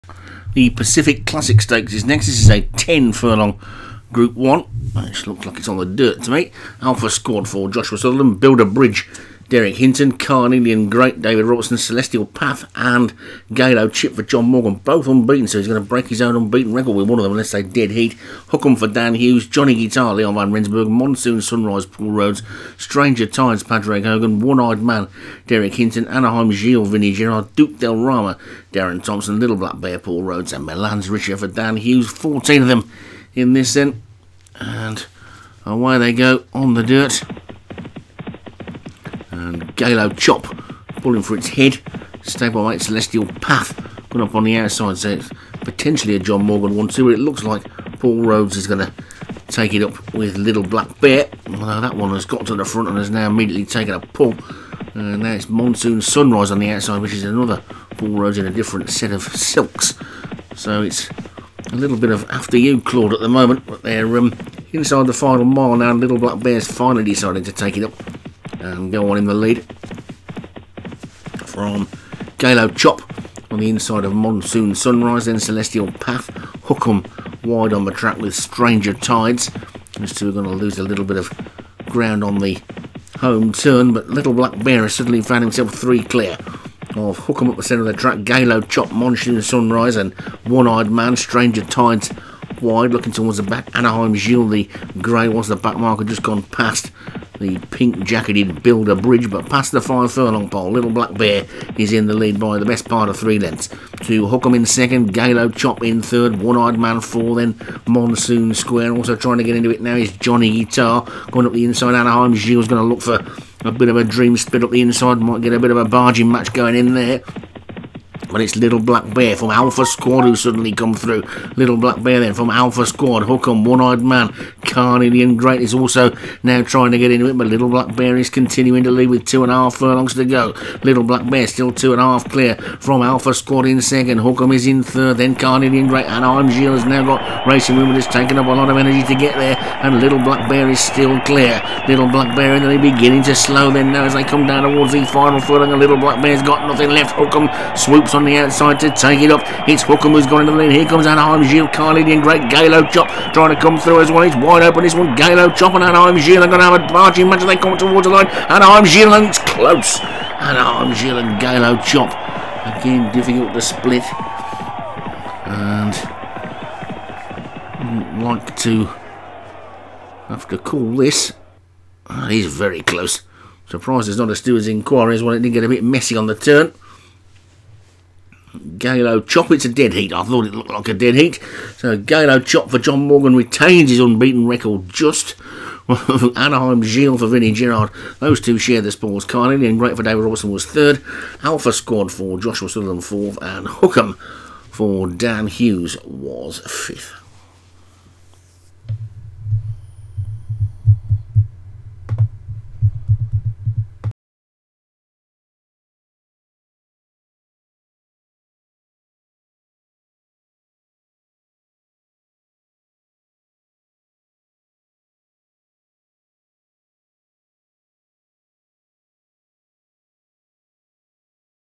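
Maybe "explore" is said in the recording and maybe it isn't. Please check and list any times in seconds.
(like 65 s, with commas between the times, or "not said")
not said.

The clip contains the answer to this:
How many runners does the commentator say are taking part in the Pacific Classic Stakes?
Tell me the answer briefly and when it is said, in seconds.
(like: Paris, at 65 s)
14, at 32 s.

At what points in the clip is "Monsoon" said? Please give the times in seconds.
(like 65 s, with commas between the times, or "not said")
20 s, 55 s, 74 s, 88 s, 107 s.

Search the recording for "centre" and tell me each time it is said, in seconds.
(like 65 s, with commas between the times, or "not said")
87 s.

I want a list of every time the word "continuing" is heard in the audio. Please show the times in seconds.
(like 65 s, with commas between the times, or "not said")
128 s.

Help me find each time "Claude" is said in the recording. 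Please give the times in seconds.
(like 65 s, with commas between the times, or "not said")
62 s.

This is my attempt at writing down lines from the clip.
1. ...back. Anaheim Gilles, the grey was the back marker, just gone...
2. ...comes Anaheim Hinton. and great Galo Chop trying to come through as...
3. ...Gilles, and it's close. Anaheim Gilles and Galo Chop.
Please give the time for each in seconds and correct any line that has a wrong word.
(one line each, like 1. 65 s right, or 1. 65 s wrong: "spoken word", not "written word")
1. 93 s right
2. 150 s wrong: "Gilles", not "Hinton"
3. 158 s right.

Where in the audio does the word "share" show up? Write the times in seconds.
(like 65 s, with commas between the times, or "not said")
188 s.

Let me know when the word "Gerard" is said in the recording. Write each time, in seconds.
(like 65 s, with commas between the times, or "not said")
27 s, 187 s.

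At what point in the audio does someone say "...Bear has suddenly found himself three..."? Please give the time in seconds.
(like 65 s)
84 s.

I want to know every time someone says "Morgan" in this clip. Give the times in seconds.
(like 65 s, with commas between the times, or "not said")
14 s, 46 s, 183 s.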